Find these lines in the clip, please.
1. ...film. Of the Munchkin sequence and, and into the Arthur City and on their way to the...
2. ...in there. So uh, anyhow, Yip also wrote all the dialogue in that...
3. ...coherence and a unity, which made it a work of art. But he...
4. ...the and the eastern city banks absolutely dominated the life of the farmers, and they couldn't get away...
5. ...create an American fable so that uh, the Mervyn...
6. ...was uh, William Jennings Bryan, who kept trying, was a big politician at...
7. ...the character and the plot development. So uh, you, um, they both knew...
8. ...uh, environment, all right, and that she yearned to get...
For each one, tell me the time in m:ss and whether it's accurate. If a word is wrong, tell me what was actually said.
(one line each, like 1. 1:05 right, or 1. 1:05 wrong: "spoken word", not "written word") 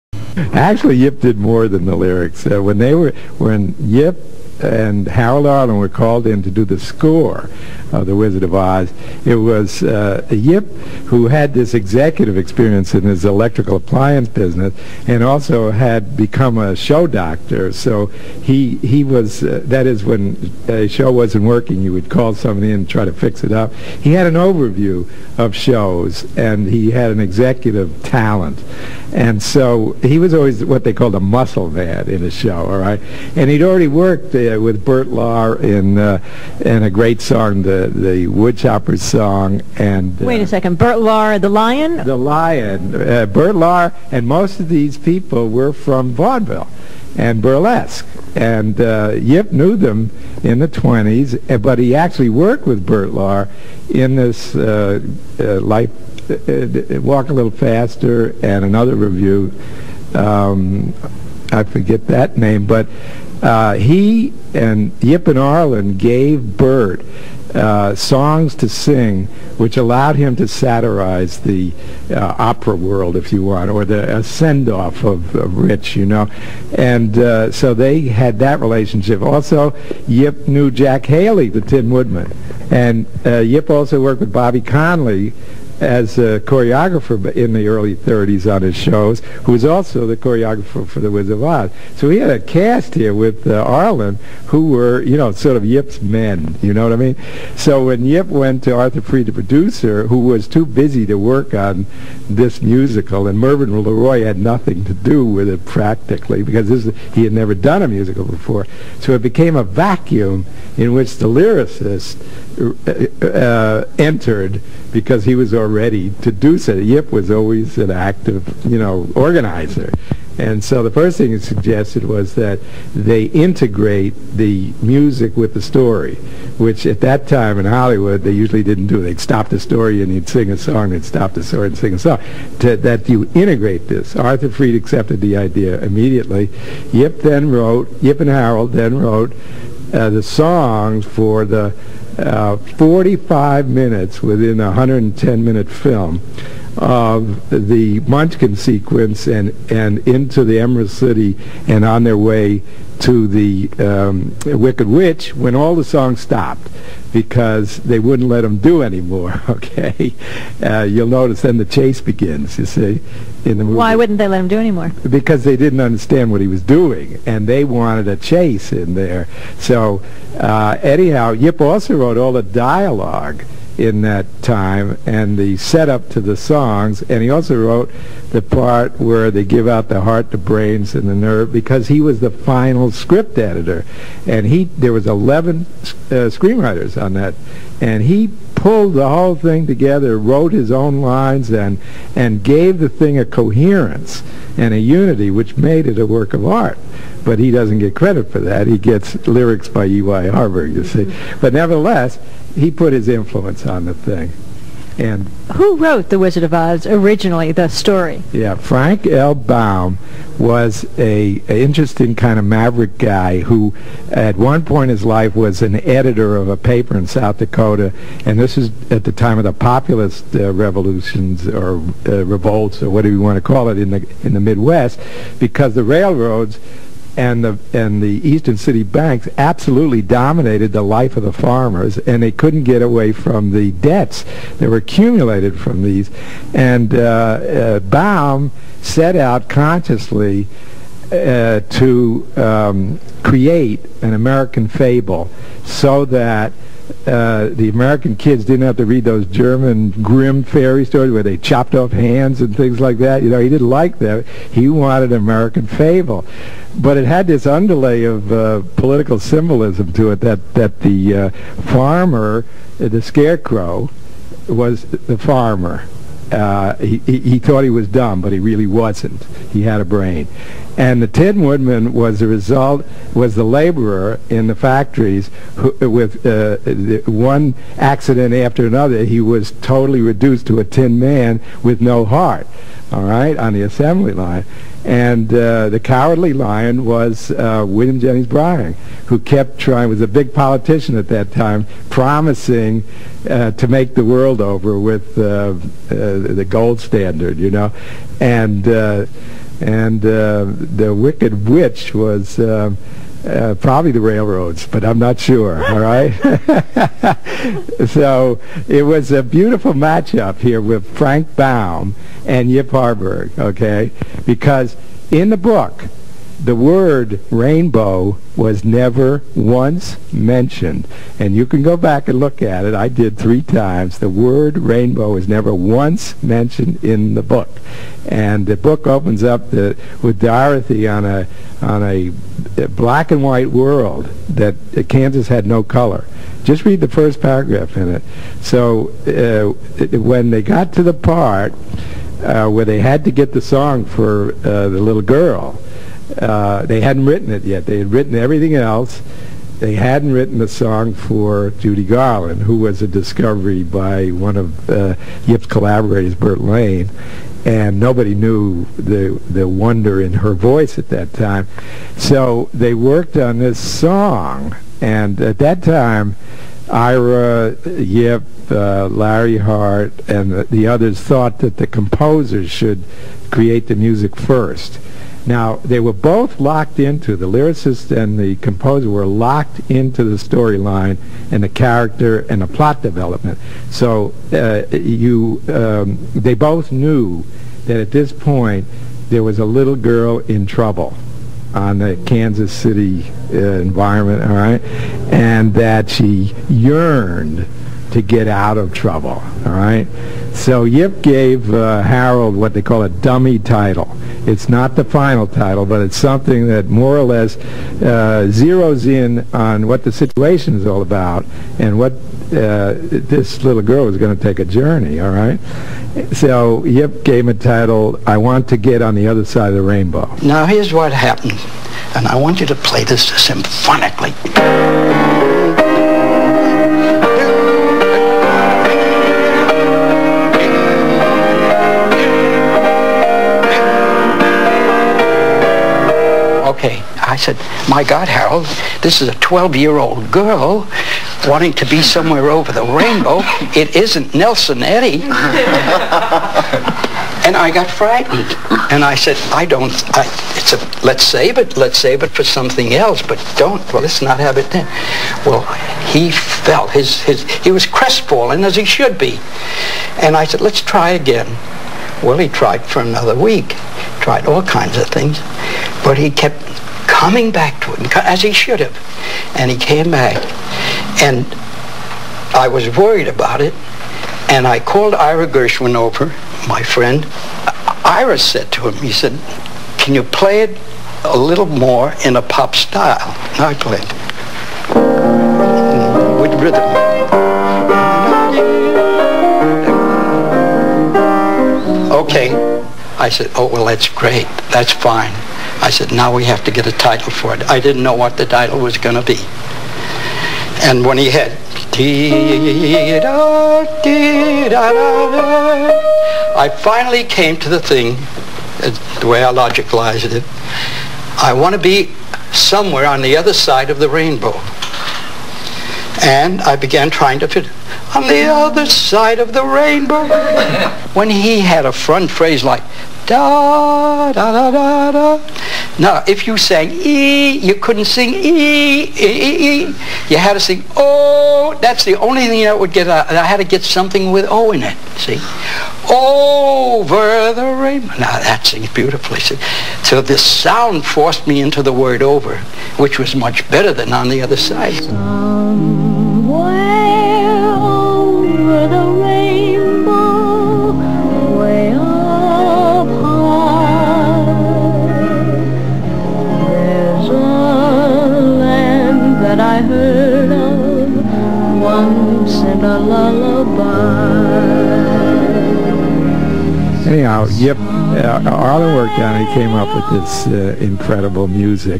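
1. 2:25 wrong: "Emerald", not "Arthur"
2. 2:48 right
3. 3:13 right
4. 3:47 right
5. 4:03 wrong: "American", not "Mervyn"
6. 4:46 right
7. 6:21 right
8. 6:33 right.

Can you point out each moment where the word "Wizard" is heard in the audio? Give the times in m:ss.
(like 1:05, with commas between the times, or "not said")
0:08, 1:31, 3:26.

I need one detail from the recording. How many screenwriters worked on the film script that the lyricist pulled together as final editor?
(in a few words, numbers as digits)
11.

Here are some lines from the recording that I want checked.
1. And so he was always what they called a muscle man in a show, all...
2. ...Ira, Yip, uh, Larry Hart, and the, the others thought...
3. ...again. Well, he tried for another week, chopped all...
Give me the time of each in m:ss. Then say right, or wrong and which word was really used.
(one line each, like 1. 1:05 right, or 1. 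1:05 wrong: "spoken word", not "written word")
1. 0:29 right
2. 6:06 right
3. 7:40 wrong: "tried", not "chopped".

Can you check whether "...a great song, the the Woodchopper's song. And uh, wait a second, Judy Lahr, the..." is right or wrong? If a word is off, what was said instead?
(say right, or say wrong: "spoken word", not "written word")
wrong: "Bert", not "Judy".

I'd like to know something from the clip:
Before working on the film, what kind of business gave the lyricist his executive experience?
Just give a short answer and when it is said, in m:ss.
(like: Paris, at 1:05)
Electrical appliance business, at 0:13.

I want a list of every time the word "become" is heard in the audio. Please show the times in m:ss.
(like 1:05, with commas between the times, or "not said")
0:16.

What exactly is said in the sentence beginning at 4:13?
You know, he didn't like that.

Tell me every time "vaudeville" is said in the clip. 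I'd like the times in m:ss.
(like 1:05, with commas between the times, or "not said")
0:46.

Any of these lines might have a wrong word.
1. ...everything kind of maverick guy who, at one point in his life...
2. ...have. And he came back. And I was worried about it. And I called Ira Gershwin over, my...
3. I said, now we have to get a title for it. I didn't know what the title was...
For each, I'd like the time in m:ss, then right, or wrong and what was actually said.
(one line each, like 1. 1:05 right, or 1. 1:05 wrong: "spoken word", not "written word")
1. 3:31 wrong: "interesting", not "everything"
2. 7:48 right
3. 8:15 right.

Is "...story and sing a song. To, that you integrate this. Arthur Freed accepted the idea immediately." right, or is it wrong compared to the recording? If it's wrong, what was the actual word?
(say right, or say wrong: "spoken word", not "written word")
right.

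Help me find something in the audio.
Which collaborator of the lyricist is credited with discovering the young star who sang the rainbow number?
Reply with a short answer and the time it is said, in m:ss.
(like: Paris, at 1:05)
Burt Lane, at 5:56.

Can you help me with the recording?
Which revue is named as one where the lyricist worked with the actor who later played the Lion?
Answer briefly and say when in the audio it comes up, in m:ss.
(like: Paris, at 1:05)
Walk a Little Faster, at 0:57.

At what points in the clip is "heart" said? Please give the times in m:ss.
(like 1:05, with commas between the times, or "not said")
3:00, 4:42.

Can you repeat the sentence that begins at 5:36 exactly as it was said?
Just read the first paragraph in it.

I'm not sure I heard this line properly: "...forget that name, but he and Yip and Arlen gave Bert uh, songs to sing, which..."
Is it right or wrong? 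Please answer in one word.
right.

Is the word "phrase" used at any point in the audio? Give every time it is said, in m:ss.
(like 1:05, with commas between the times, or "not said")
8:42.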